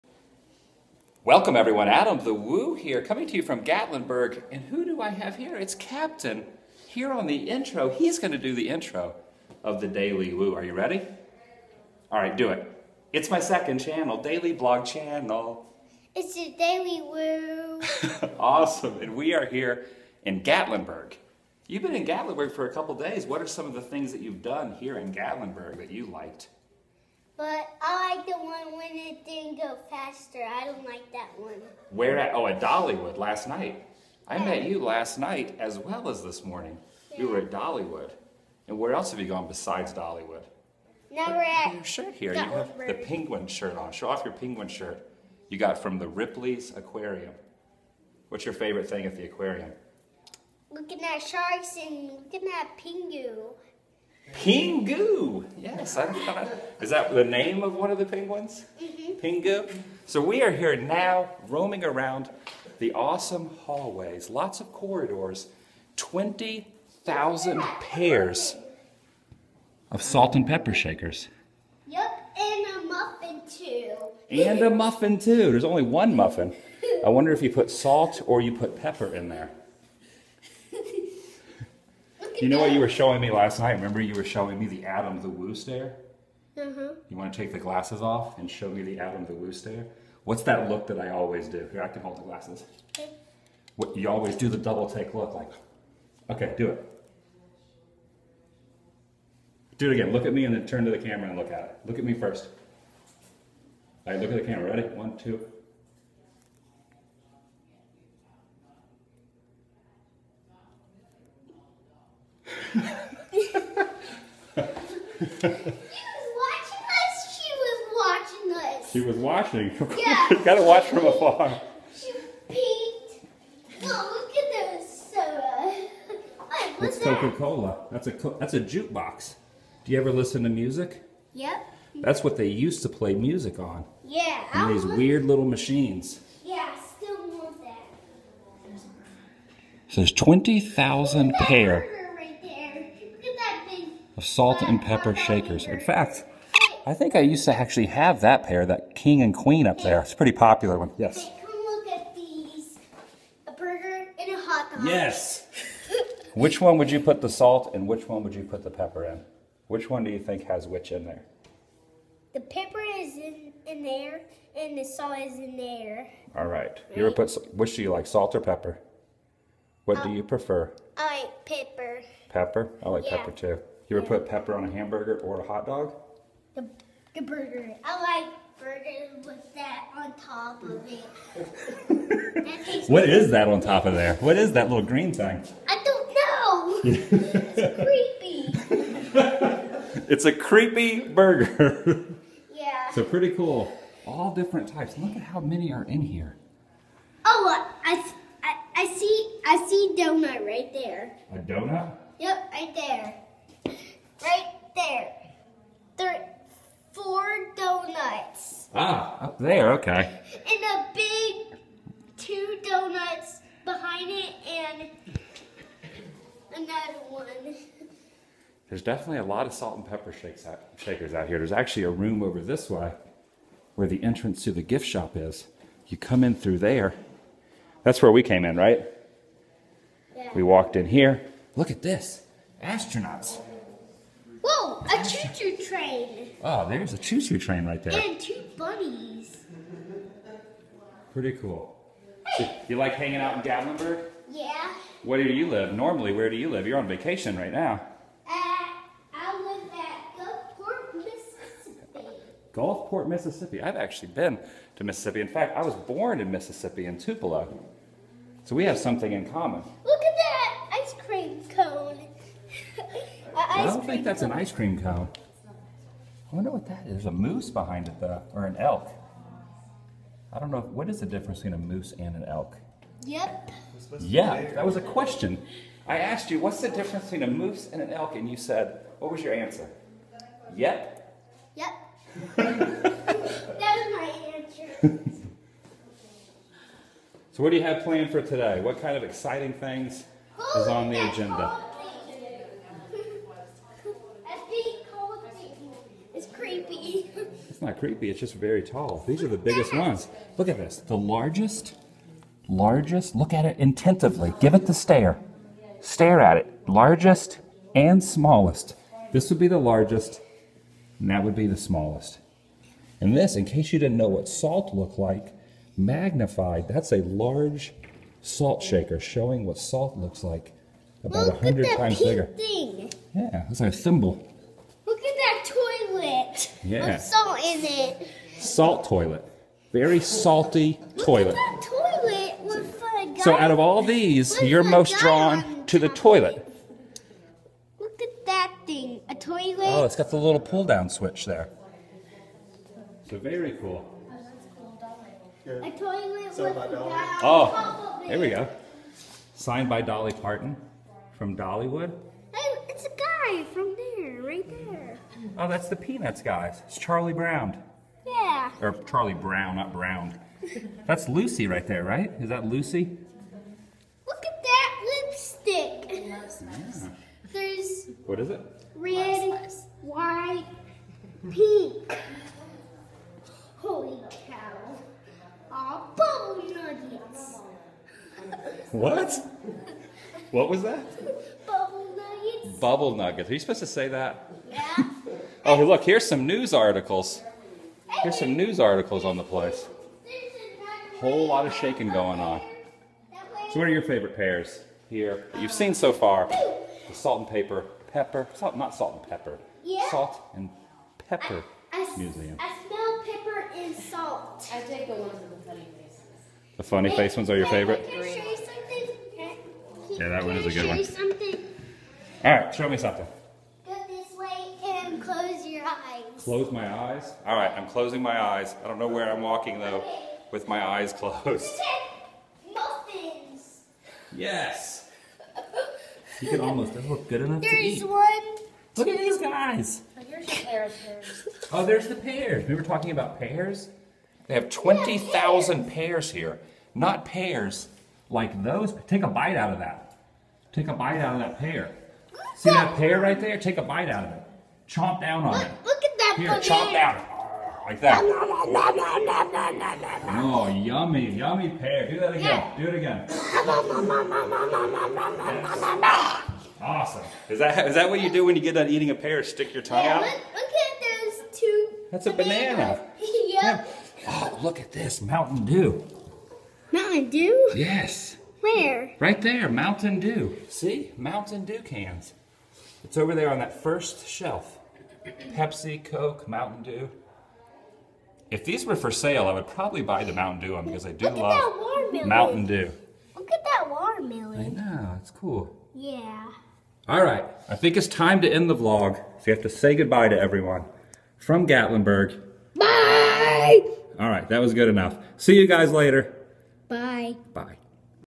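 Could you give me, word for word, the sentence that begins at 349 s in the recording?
Signed by Dolly Parton from Dollywood.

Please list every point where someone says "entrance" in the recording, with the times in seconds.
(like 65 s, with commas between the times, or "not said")
224 s.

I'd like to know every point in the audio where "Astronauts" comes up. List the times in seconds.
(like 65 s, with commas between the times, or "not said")
232 s.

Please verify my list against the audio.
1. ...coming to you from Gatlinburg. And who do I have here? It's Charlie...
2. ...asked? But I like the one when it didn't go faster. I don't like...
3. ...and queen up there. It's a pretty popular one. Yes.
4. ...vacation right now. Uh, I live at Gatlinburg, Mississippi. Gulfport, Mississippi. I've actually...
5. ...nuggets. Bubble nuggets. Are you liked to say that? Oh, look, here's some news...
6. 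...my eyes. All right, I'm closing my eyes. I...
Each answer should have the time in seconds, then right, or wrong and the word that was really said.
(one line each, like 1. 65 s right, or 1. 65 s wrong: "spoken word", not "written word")
1. 3 s wrong: "Captain", not "Charlie"
2. 26 s wrong: "liked", not "asked"
3. 149 s right
4. 246 s wrong: "Gulfport", not "Gatlinburg"
5. 381 s wrong: "supposed", not "liked"
6. 416 s right.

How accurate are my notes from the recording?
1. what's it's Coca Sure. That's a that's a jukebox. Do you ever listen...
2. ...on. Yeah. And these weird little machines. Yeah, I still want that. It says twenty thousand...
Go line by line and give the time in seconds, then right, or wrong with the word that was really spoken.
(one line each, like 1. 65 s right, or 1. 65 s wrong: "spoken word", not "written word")
1. 126 s wrong: "Cola", not "Sure"
2. 133 s right.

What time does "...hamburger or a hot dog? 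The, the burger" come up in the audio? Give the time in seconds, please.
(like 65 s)
174 s.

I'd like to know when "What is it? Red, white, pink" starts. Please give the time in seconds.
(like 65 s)
368 s.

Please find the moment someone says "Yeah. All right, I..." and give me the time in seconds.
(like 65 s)
485 s.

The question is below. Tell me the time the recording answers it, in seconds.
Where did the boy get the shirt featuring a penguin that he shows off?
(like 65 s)
46 s.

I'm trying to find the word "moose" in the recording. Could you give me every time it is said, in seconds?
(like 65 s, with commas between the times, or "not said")
267 s, 271 s, 277 s.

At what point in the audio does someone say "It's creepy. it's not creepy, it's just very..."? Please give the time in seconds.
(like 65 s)
296 s.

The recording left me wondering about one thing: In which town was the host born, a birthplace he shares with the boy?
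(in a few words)
Tupelo.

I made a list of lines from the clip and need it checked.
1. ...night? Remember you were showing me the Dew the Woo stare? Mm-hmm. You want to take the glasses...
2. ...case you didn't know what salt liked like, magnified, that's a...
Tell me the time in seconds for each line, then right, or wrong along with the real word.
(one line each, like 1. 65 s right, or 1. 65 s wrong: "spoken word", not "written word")
1. 83 s wrong: "Adam", not "Dew"
2. 313 s wrong: "looked", not "liked".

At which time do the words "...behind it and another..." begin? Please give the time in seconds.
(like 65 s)
213 s.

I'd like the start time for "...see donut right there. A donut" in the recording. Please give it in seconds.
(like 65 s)
199 s.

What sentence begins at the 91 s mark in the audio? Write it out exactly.
Here, I can hold the glasses.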